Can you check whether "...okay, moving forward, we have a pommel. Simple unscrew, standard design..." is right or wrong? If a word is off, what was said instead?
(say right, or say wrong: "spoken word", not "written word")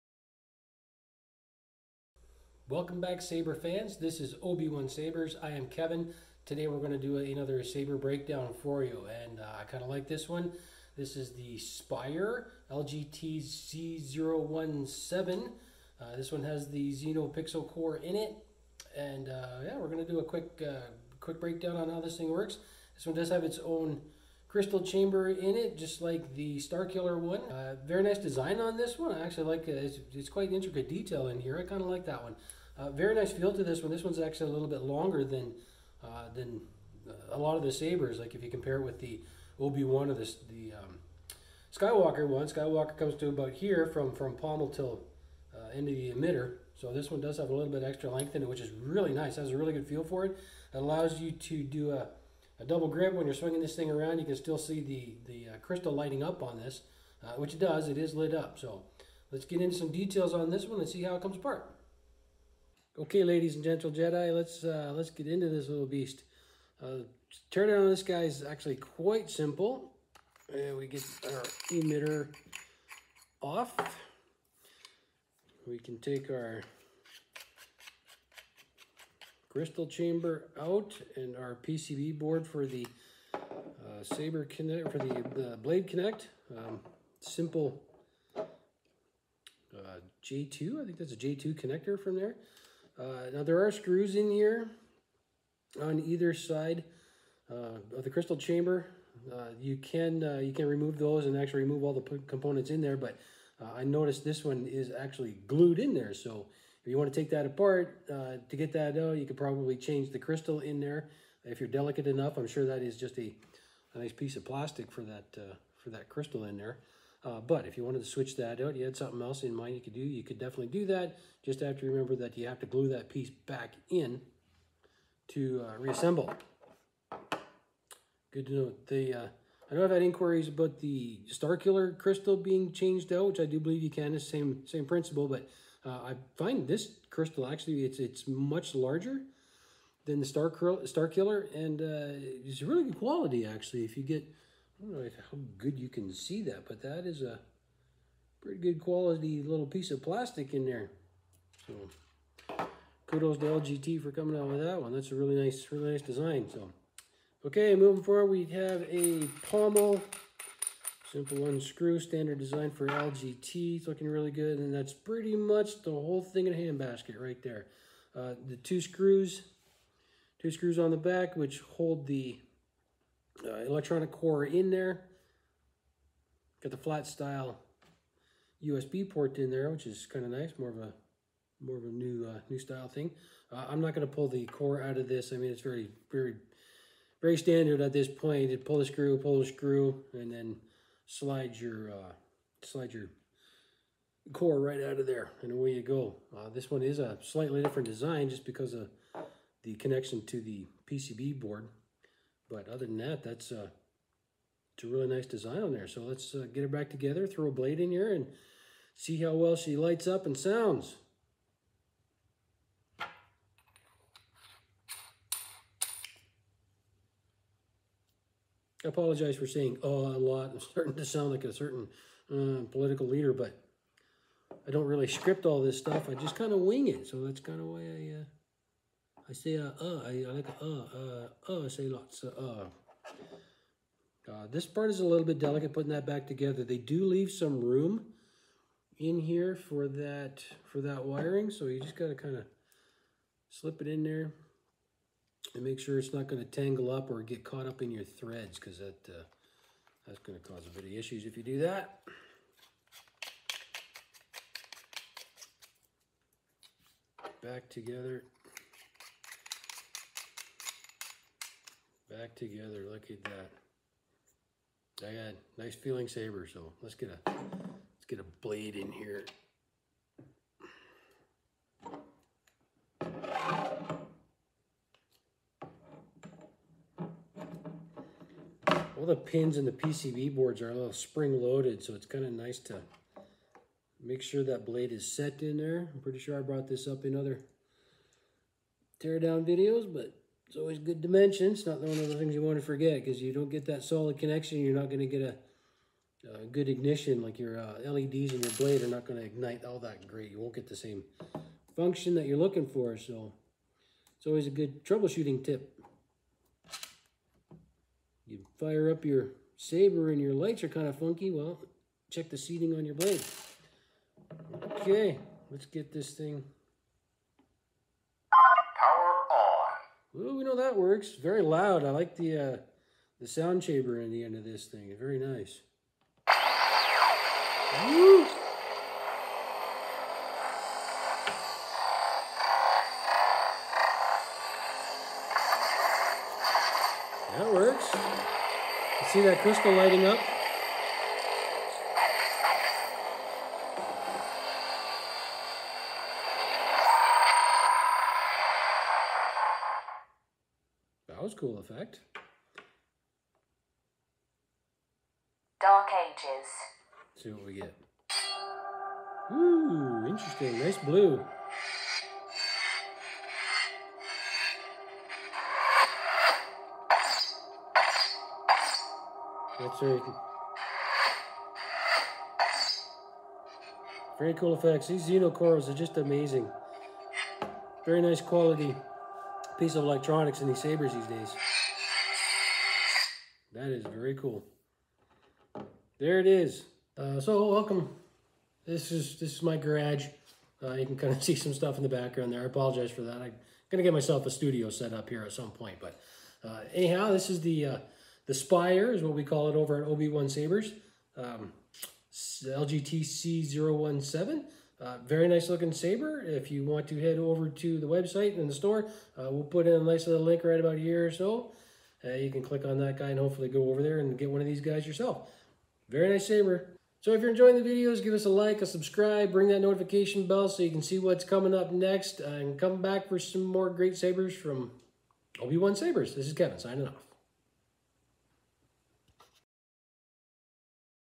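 right.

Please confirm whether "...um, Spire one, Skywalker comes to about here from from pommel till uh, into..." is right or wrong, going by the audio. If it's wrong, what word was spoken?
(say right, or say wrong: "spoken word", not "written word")
wrong: "Skywalker", not "Spire".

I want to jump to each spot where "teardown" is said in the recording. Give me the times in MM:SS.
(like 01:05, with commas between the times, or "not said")
04:49.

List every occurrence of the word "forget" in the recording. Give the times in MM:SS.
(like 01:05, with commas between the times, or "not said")
04:52.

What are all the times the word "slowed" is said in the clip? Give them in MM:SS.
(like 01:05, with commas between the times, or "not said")
not said.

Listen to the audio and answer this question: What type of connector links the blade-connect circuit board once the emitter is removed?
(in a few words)
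J2 connector.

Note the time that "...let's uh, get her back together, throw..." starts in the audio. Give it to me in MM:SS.
03:26.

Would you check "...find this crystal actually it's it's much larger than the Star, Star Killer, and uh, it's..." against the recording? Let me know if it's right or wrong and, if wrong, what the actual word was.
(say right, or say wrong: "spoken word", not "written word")
right.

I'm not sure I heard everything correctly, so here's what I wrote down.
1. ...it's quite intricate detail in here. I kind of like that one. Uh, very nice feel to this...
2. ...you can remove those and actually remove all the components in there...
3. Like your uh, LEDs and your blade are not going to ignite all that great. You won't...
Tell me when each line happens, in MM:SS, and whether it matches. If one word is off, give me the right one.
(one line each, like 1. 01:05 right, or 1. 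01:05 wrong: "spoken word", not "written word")
1. 00:30 right
2. 01:40 right
3. 04:57 right.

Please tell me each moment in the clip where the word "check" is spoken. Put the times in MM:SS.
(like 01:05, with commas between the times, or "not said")
05:12.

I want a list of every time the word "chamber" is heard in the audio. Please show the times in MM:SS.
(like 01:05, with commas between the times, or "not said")
00:24, 01:19, 01:38.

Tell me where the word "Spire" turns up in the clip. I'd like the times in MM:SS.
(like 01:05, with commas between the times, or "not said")
00:11, 06:38.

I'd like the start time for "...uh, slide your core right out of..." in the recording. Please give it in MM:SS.
03:11.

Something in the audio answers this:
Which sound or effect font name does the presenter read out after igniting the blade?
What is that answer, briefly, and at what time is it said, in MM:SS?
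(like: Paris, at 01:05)
Dark Ages, at 05:55.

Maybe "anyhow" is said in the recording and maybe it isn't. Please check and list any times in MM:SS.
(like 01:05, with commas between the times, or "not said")
06:36.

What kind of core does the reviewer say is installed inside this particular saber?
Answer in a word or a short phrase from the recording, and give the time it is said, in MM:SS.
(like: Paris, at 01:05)
Xeno Pixel Core, at 00:16.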